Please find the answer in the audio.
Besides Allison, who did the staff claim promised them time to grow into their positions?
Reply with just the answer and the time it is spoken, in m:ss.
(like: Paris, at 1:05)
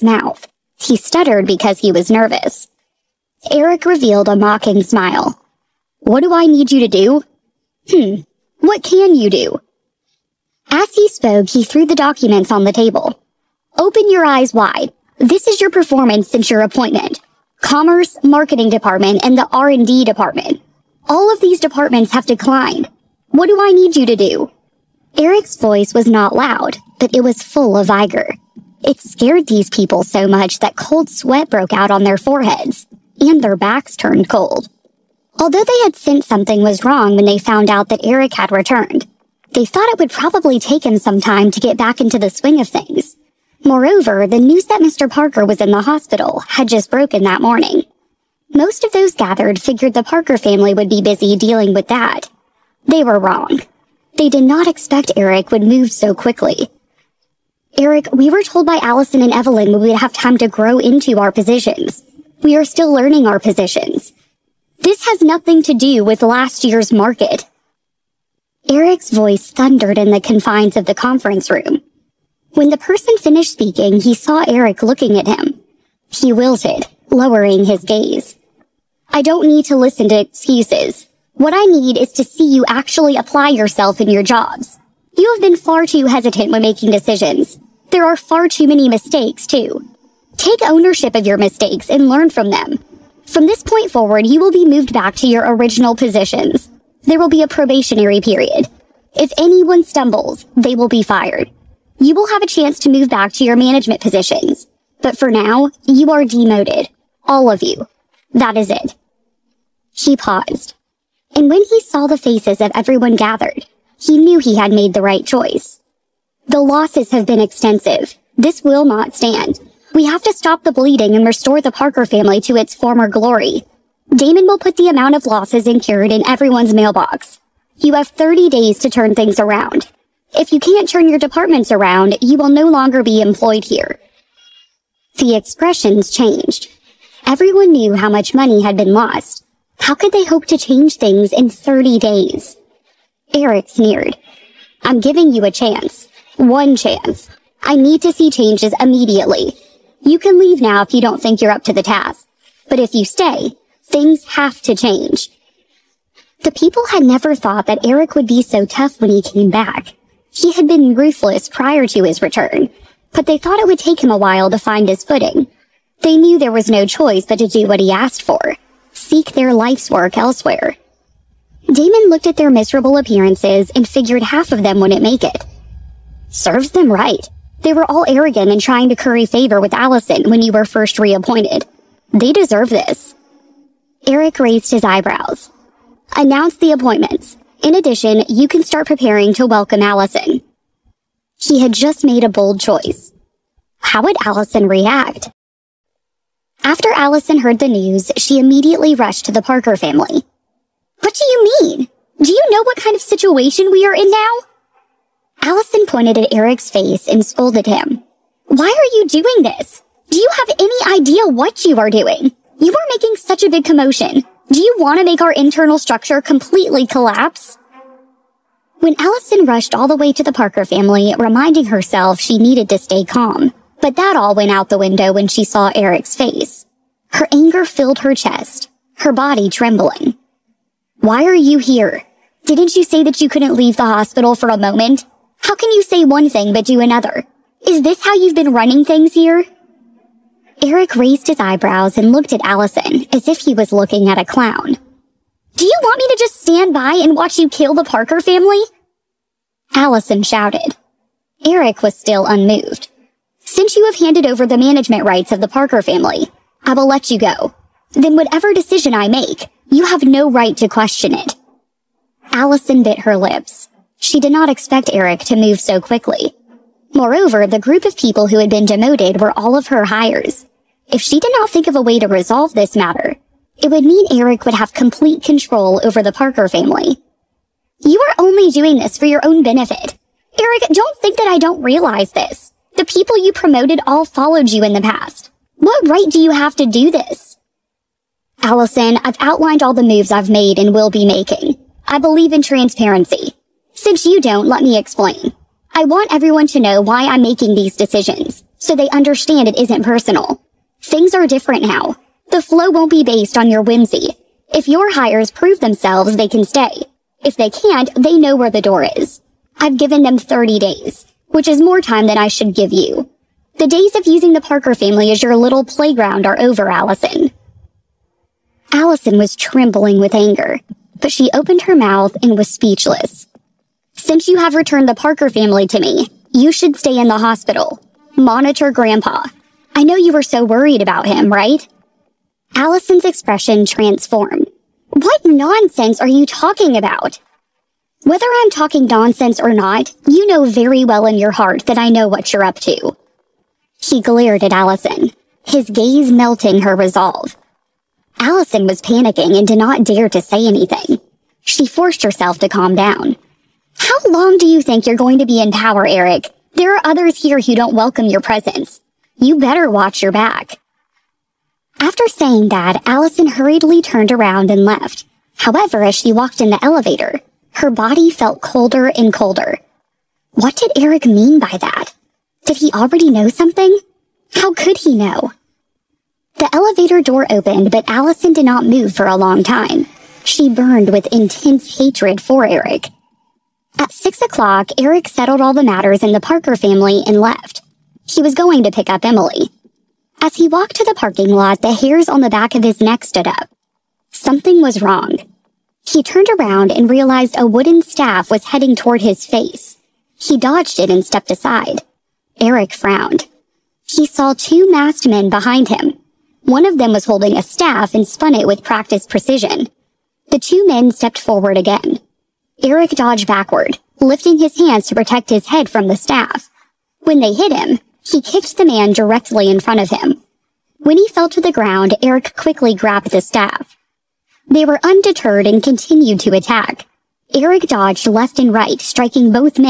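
Evelyn, at 0:59.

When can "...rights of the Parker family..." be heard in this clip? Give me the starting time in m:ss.
4:15.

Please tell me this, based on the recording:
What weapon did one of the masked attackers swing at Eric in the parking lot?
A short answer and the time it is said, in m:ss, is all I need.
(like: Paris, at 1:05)
wooden staff, at 6:37.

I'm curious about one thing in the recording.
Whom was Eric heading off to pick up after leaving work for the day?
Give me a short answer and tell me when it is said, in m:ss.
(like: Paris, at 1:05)
Emily, at 6:29.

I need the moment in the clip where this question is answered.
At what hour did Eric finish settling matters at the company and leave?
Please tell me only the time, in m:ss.
6:23.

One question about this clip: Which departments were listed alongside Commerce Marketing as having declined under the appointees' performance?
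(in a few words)
R&D Department.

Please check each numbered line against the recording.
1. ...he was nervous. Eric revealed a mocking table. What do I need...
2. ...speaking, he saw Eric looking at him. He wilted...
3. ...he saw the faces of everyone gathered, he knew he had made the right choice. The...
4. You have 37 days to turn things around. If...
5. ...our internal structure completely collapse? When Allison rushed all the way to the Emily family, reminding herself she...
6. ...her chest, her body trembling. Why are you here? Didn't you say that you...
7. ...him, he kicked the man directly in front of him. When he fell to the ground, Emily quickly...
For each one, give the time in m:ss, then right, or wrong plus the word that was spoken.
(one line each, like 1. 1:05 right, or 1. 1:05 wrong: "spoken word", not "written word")
1. 0:01 wrong: "smile", not "table"
2. 1:13 right
3. 1:51 right
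4. 2:07 wrong: "30", not "37"
5. 3:35 wrong: "Parker", not "Emily"
6. 3:47 right
7. 6:57 wrong: "Eric", not "Emily".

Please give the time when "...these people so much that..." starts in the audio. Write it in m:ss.
0:29.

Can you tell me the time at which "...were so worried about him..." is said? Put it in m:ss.
5:30.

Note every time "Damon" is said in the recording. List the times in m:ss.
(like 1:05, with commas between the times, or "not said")
2:04, 2:51.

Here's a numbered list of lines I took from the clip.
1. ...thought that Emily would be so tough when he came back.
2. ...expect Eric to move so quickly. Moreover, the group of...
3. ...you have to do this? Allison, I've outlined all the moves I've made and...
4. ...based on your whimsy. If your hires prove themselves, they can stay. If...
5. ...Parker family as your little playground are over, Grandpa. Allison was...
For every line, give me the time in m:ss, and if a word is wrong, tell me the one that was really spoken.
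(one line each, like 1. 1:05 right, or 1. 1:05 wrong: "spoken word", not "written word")
1. 2:37 wrong: "Eric", not "Emily"
2. 4:24 right
3. 4:46 right
4. 5:03 right
5. 5:14 wrong: "Allison", not "Grandpa".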